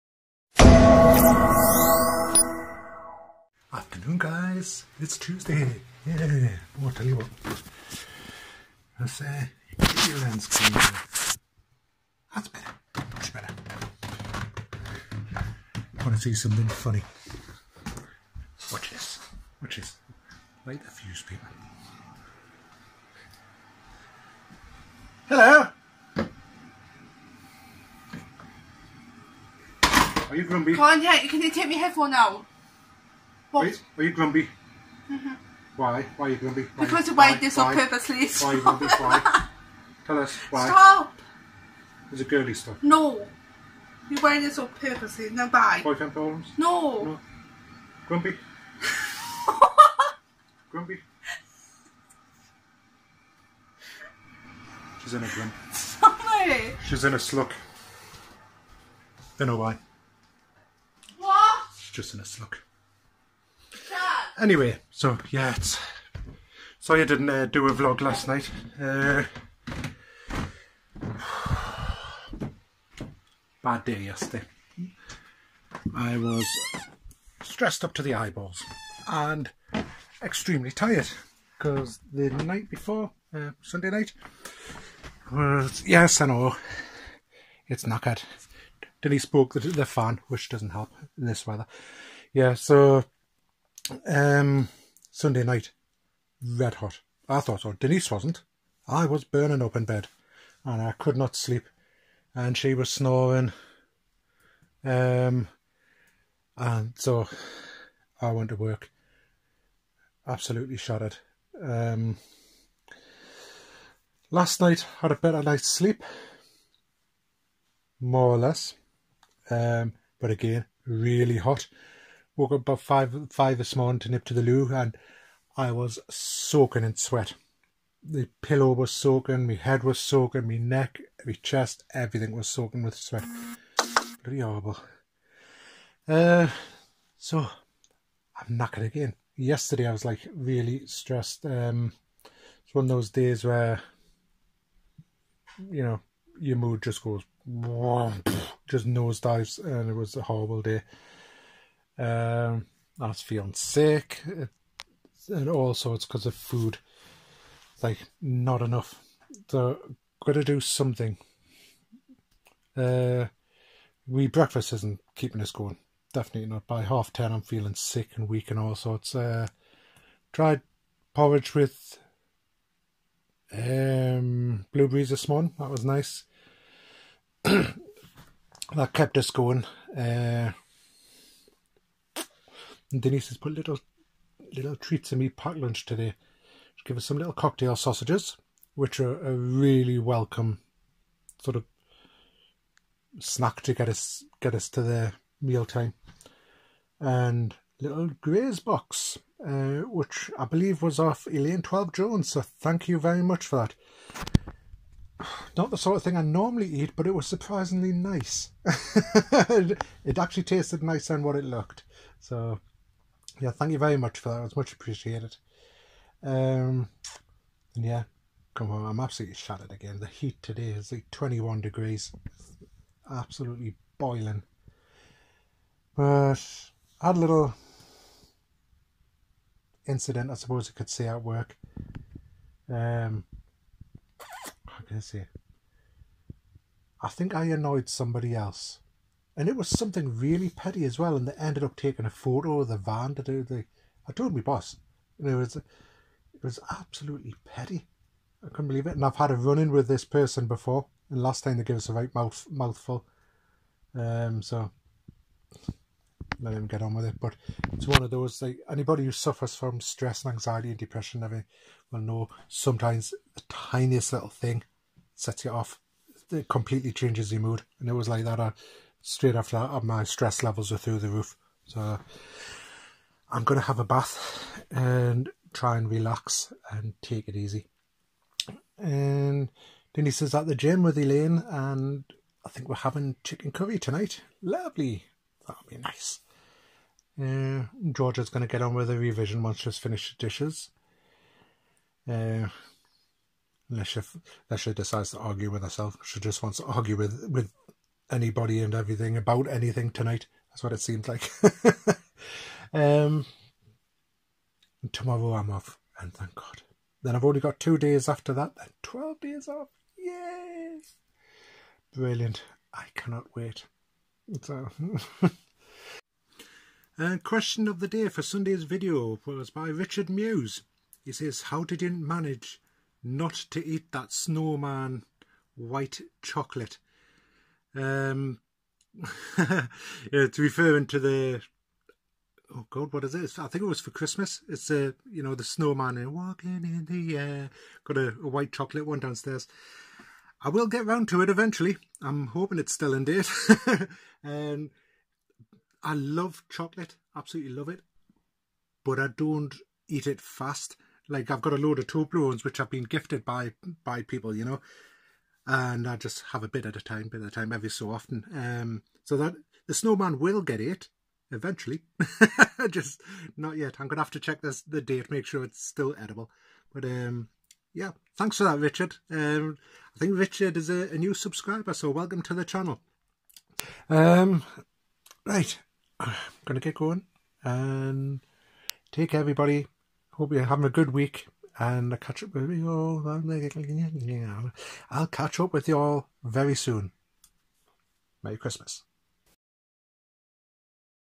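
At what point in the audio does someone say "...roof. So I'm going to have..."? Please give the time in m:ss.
4:31.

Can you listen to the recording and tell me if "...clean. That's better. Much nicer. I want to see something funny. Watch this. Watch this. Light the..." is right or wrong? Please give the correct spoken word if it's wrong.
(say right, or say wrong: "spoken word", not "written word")
wrong: "better", not "nicer".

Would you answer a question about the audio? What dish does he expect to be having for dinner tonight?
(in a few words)
Chicken curry.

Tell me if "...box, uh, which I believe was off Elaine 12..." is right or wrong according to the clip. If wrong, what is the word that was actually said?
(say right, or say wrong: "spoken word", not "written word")
right.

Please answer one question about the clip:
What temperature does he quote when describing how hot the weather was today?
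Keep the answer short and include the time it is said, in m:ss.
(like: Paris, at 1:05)
21 degrees, at 3:41.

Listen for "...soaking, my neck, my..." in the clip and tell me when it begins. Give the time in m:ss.
2:09.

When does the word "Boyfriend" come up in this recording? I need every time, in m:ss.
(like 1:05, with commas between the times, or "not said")
0:45.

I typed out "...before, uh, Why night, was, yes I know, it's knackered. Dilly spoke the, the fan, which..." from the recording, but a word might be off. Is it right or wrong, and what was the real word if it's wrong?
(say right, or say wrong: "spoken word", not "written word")
wrong: "Sunday", not "Why".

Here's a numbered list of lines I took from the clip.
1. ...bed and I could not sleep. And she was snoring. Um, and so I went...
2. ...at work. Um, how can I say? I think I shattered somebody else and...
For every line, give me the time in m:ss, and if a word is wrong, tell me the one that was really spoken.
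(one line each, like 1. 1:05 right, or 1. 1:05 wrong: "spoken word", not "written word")
1. 1:39 right
2. 3:51 wrong: "annoyed", not "shattered".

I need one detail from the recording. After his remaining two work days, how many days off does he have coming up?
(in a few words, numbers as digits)
12.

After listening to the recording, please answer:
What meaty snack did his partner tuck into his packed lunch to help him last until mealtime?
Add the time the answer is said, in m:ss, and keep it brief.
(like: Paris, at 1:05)
Cocktail sausages, at 3:07.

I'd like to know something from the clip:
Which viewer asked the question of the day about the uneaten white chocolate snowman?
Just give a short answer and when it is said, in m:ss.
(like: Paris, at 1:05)
Richard Muse, at 5:19.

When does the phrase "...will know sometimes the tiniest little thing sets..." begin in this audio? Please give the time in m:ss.
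4:21.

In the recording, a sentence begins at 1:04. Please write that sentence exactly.
Anyway, so yeah, it's, sorry I didn't uh, do a vlog last night.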